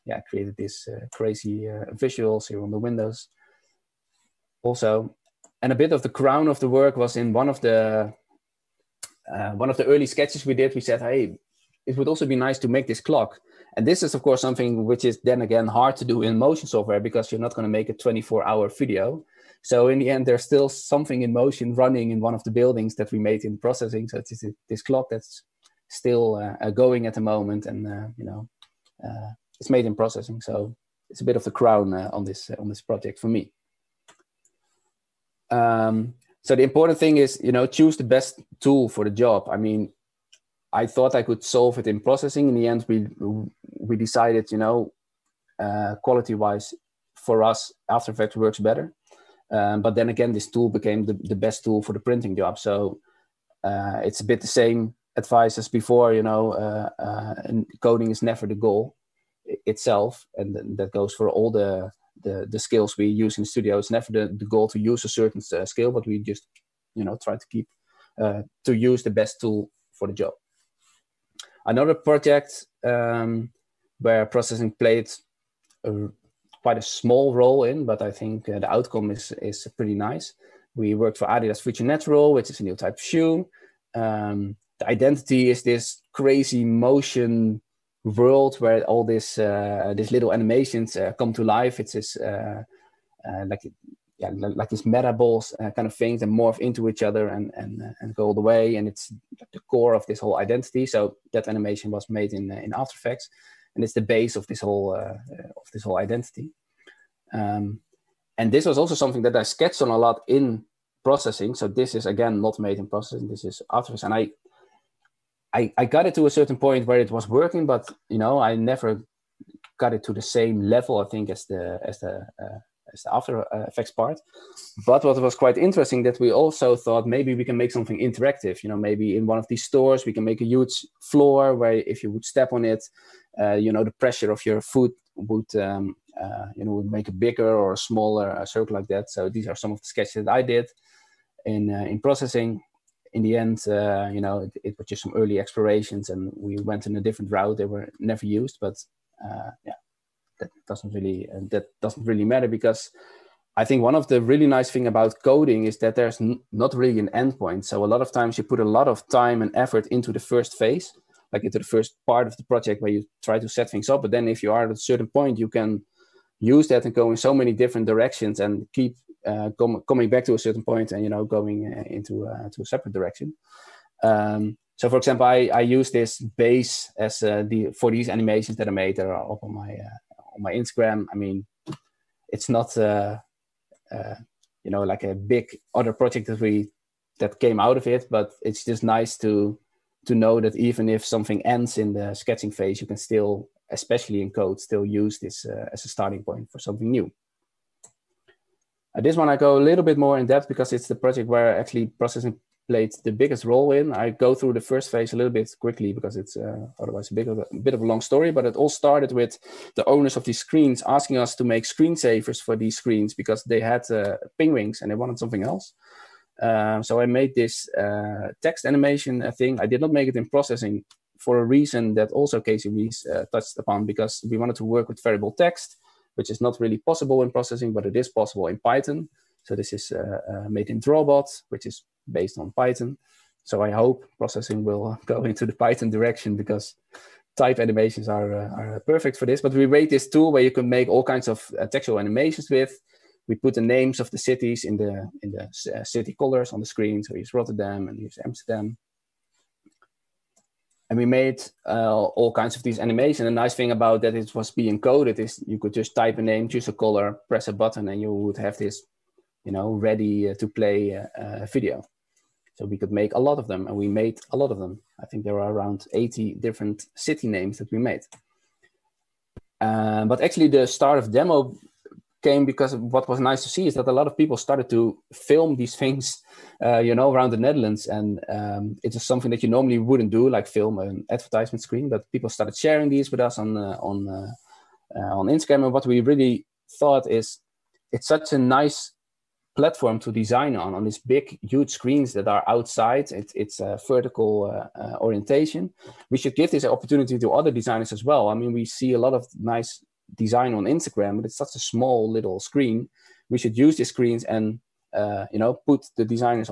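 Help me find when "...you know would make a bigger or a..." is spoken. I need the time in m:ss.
2:16.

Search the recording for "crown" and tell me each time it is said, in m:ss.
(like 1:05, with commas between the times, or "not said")
0:06, 0:31.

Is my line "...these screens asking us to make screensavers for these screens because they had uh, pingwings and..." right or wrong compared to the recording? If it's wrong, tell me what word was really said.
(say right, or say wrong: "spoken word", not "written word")
right.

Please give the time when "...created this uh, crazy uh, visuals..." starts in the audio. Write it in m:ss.
0:00.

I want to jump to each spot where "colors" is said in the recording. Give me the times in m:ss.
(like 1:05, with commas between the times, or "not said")
4:06, 4:16.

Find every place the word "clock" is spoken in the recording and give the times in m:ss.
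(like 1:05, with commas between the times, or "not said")
0:13, 0:24.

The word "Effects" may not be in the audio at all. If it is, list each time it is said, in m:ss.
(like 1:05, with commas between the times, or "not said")
0:48, 1:42, 1:53, 2:03.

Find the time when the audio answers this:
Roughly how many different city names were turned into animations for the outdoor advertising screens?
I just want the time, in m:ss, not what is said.
4:25.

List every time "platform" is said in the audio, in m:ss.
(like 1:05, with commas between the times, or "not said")
4:49.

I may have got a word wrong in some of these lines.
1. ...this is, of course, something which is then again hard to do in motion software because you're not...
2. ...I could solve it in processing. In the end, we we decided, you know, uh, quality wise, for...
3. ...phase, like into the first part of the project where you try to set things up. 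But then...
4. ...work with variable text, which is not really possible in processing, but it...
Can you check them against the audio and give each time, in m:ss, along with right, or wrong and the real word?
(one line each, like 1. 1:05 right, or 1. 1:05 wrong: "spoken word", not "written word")
1. 0:13 right
2. 0:41 right
3. 2:40 right
4. 3:44 right.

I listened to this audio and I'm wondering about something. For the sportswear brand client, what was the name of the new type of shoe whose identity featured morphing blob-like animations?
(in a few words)
Future Natural.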